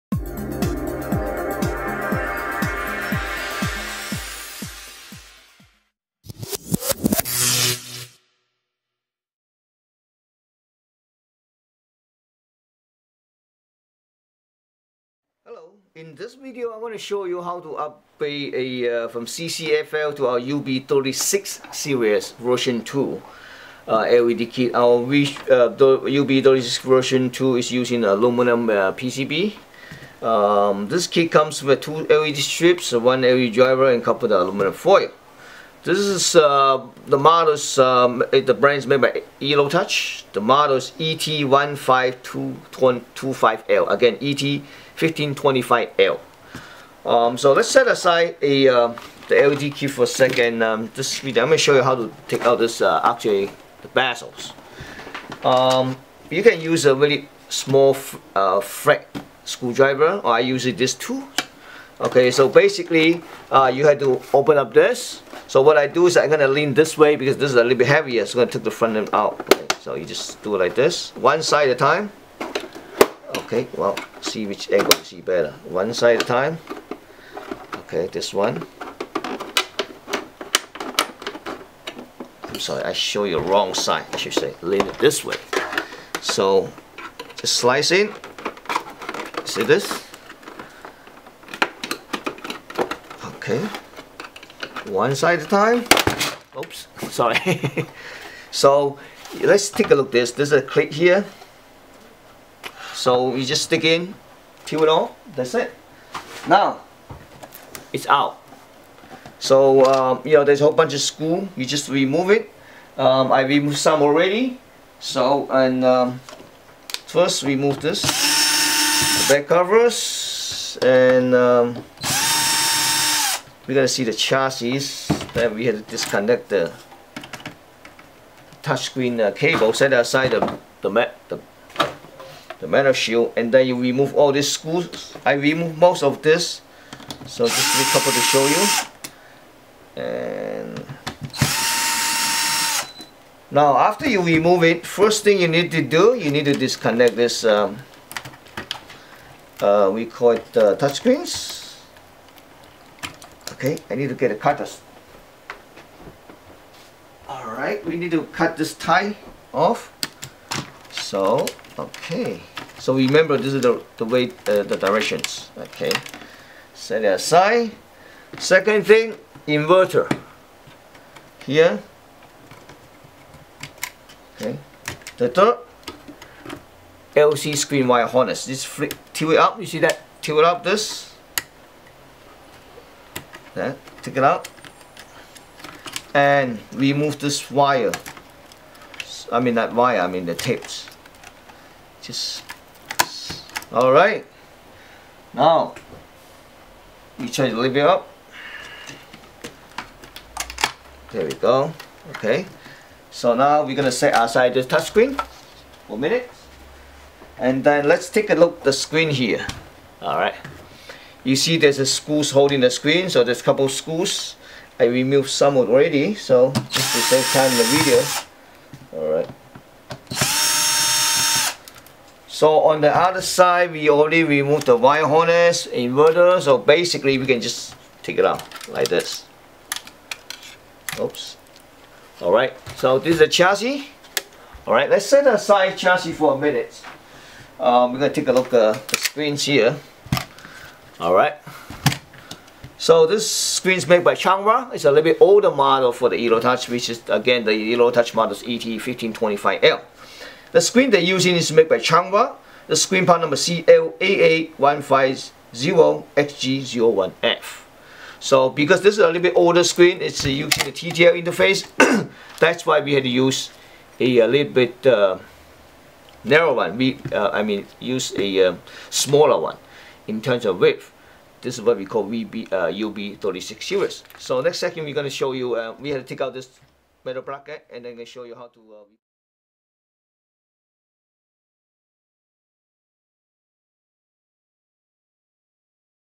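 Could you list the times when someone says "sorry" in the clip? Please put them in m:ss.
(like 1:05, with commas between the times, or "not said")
1:22, 1:37.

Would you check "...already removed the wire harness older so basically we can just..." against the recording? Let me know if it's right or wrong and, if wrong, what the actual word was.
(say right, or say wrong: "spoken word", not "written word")
wrong: "inverter", not "older".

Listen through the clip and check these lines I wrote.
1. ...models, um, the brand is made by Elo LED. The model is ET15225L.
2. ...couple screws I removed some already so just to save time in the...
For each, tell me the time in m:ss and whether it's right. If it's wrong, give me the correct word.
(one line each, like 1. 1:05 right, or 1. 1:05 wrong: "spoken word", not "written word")
1. 0:37 wrong: "Touch", not "LED"
2. 3:33 right.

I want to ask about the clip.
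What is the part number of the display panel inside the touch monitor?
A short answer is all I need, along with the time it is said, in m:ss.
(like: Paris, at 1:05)
CLAA1550XG01F, at 4:13.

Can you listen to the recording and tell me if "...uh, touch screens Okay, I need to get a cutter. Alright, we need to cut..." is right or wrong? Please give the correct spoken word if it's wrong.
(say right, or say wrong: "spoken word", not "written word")
right.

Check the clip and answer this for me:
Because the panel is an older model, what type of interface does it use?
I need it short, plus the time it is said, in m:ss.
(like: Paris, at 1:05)
TTL, at 4:20.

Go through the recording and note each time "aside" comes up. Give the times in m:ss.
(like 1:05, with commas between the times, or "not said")
0:47, 2:09, 2:47, 3:24, 3:55.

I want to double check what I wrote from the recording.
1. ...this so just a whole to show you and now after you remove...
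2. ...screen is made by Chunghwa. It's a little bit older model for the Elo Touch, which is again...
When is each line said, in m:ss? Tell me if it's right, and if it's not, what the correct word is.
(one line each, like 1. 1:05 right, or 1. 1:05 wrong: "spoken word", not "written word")
1. 2:16 wrong: "couple", not "whole"
2. 4:03 right.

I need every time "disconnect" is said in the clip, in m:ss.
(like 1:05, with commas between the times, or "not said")
2:05, 2:26.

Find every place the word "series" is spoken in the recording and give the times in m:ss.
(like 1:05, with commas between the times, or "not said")
0:21, 4:33.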